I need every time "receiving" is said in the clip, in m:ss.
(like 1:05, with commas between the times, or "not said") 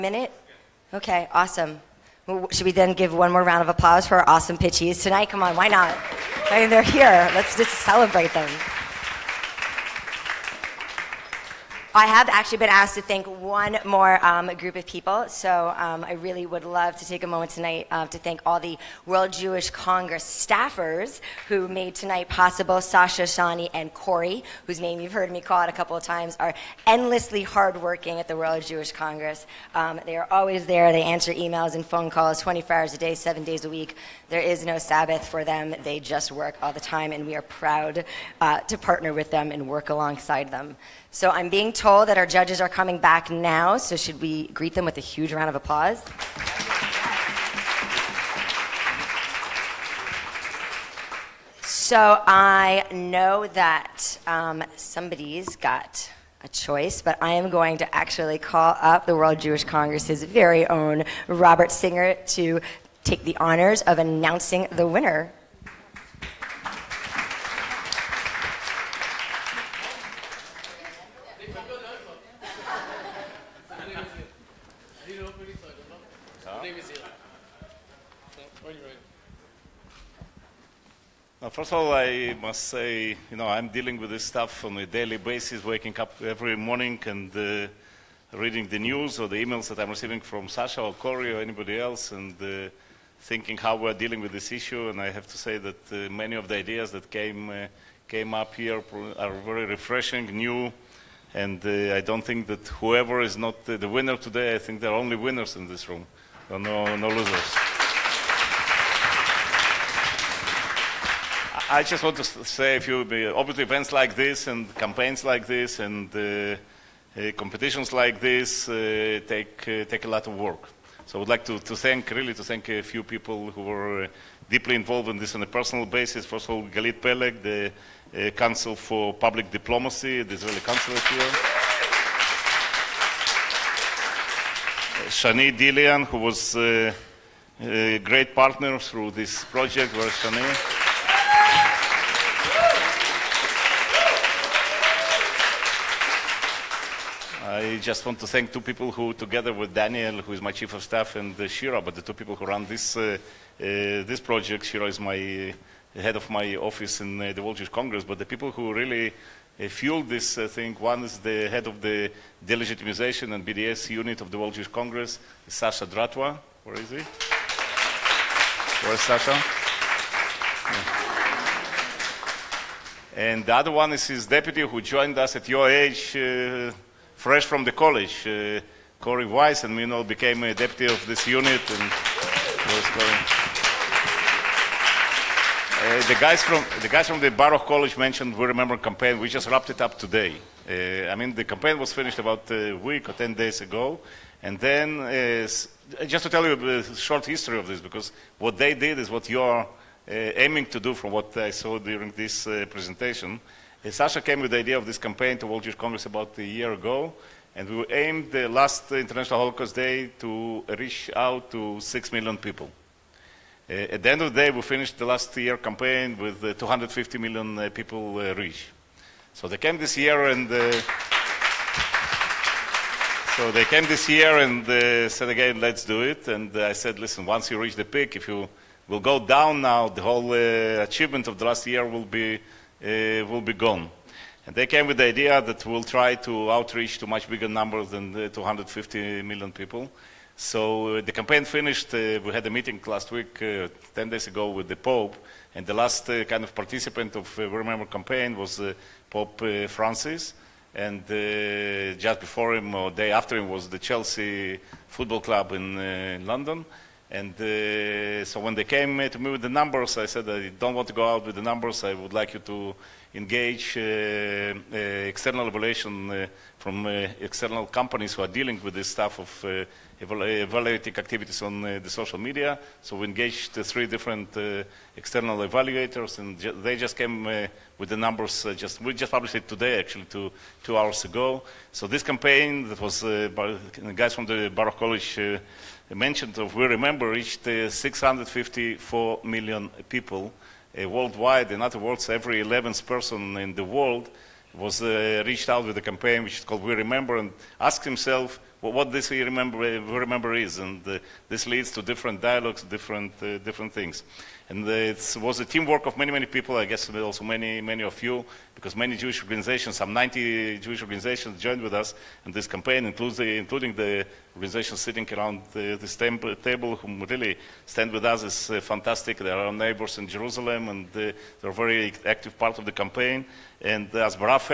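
1:29.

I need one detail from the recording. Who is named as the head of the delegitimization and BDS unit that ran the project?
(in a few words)
Sasha Dratwa.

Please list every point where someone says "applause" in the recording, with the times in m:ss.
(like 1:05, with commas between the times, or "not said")
0:03, 0:45.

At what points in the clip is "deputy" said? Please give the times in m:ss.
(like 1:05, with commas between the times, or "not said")
2:54, 3:00.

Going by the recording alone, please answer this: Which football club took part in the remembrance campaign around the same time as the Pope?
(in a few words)
Chelsea Football Club.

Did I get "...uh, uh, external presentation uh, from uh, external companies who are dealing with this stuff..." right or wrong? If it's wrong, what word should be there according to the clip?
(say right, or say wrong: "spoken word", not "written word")
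wrong: "evaluation", not "presentation".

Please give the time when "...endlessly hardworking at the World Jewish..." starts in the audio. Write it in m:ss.
0:26.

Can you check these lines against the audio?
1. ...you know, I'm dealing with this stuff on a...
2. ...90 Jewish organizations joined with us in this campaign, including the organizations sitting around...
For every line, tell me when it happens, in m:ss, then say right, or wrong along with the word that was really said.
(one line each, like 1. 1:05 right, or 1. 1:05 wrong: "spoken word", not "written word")
1. 1:23 right
2. 5:09 right.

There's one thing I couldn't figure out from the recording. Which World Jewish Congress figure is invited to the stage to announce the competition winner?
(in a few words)
Robert Singer.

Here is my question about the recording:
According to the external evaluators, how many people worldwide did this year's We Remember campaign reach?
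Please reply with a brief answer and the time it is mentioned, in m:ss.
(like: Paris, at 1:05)
654 million, at 4:47.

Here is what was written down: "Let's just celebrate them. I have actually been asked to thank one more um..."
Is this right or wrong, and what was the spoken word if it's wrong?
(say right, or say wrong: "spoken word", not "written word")
right.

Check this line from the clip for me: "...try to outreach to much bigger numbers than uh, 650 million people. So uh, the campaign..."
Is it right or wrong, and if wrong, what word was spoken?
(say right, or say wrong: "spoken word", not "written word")
wrong: "250", not "650".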